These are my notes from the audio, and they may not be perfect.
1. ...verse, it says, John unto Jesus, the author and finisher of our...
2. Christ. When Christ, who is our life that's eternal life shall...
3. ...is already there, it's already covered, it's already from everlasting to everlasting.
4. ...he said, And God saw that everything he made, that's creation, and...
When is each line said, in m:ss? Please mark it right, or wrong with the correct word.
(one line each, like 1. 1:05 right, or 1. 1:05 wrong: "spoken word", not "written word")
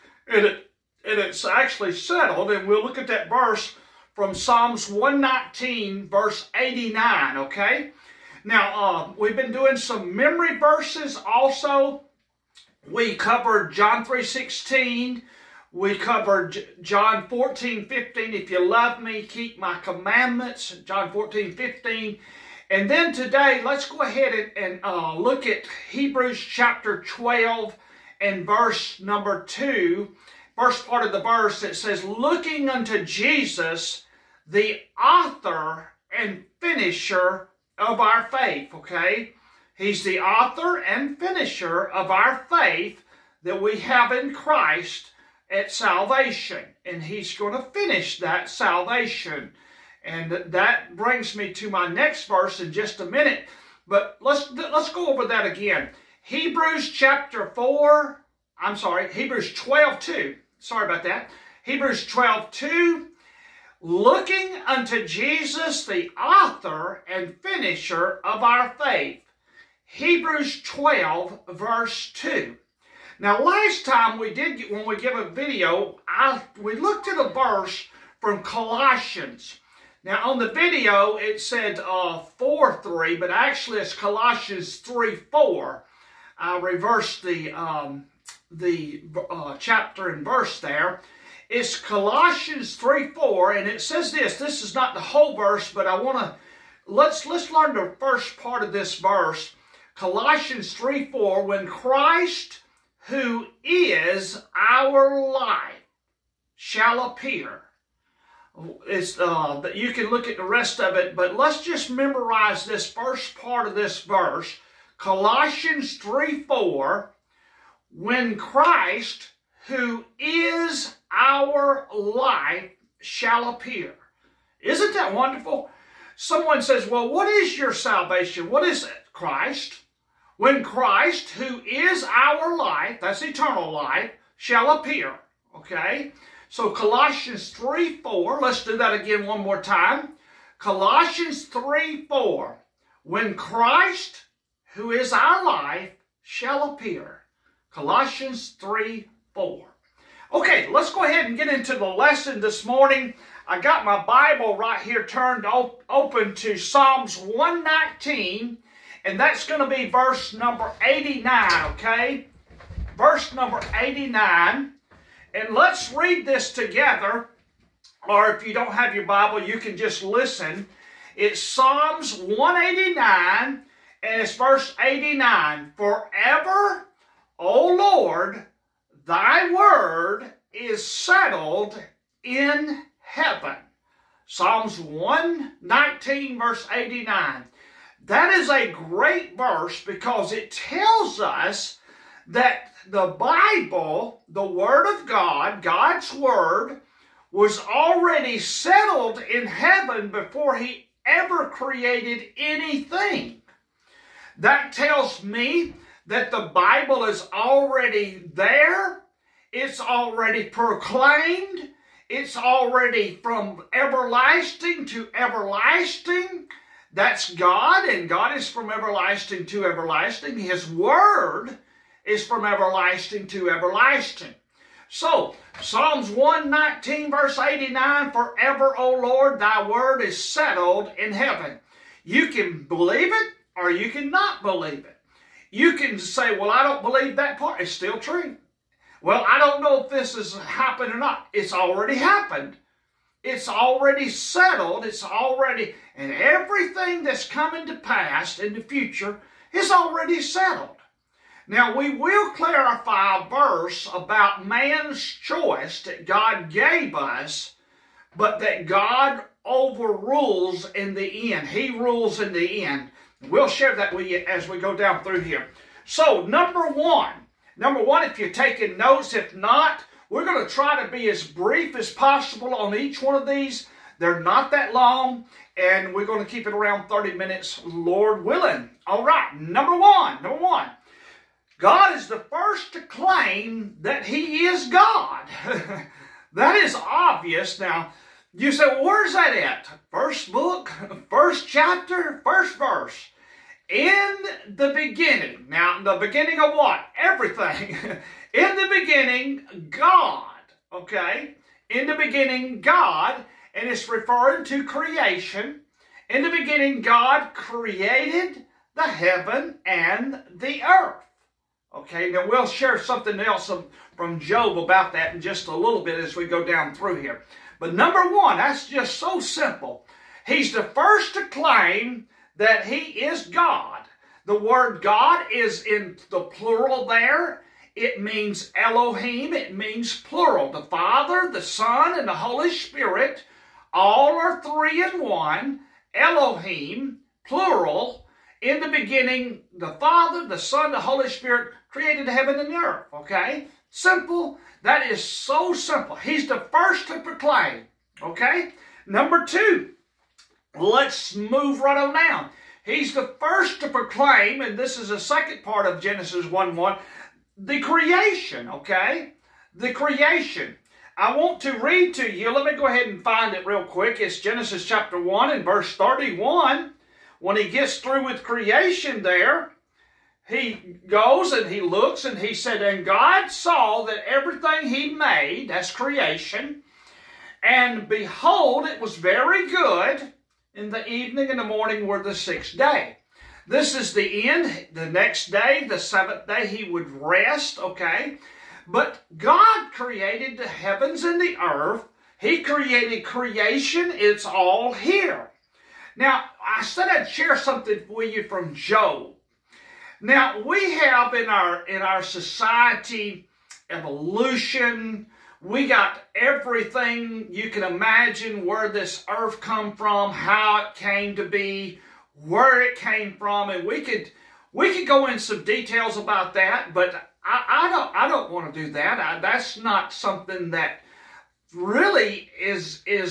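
1. 0:31 wrong: "Looking", not "John"
2. 2:09 right
3. 3:27 wrong: "proclaimed", not "covered"
4. 6:12 right.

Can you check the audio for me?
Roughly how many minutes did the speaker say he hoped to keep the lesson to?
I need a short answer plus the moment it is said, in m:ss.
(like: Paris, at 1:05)
30, at 4:36.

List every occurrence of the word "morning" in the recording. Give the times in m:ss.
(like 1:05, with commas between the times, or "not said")
2:32, 6:21.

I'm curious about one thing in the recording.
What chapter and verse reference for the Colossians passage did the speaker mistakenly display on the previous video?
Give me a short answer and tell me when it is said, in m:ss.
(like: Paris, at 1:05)
4 3, at 1:22.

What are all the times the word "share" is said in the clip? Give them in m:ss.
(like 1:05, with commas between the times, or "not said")
4:23, 5:12, 6:37.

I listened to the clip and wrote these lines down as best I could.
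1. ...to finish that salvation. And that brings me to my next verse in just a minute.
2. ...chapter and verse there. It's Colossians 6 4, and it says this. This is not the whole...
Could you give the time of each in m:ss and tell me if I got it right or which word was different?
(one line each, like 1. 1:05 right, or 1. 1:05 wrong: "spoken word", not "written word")
1. 0:47 right
2. 1:29 wrong: "3", not "6".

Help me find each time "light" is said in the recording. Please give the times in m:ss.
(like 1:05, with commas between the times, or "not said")
2:01.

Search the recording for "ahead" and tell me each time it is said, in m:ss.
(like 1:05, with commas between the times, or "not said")
0:23, 2:31, 6:02.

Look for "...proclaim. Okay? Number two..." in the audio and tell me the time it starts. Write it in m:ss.
5:46.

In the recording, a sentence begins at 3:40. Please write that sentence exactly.
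His Word is from everlasting to everlasting.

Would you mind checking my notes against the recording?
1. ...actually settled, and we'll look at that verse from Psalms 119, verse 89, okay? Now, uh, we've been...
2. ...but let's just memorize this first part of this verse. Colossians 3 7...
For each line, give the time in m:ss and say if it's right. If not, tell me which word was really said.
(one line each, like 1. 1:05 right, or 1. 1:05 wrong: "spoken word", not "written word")
1. 0:01 right
2. 1:51 wrong: "4", not "7".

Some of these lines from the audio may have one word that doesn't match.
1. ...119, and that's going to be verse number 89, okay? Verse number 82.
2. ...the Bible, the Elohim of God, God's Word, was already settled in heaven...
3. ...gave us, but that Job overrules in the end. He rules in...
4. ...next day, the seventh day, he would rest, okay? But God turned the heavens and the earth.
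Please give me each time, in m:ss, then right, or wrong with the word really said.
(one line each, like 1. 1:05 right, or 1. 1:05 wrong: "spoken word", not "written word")
1. 2:37 wrong: "89", not "82"
2. 3:12 wrong: "Word", not "Elohim"
3. 4:16 wrong: "God", not "Job"
4. 6:24 wrong: "created", not "turned".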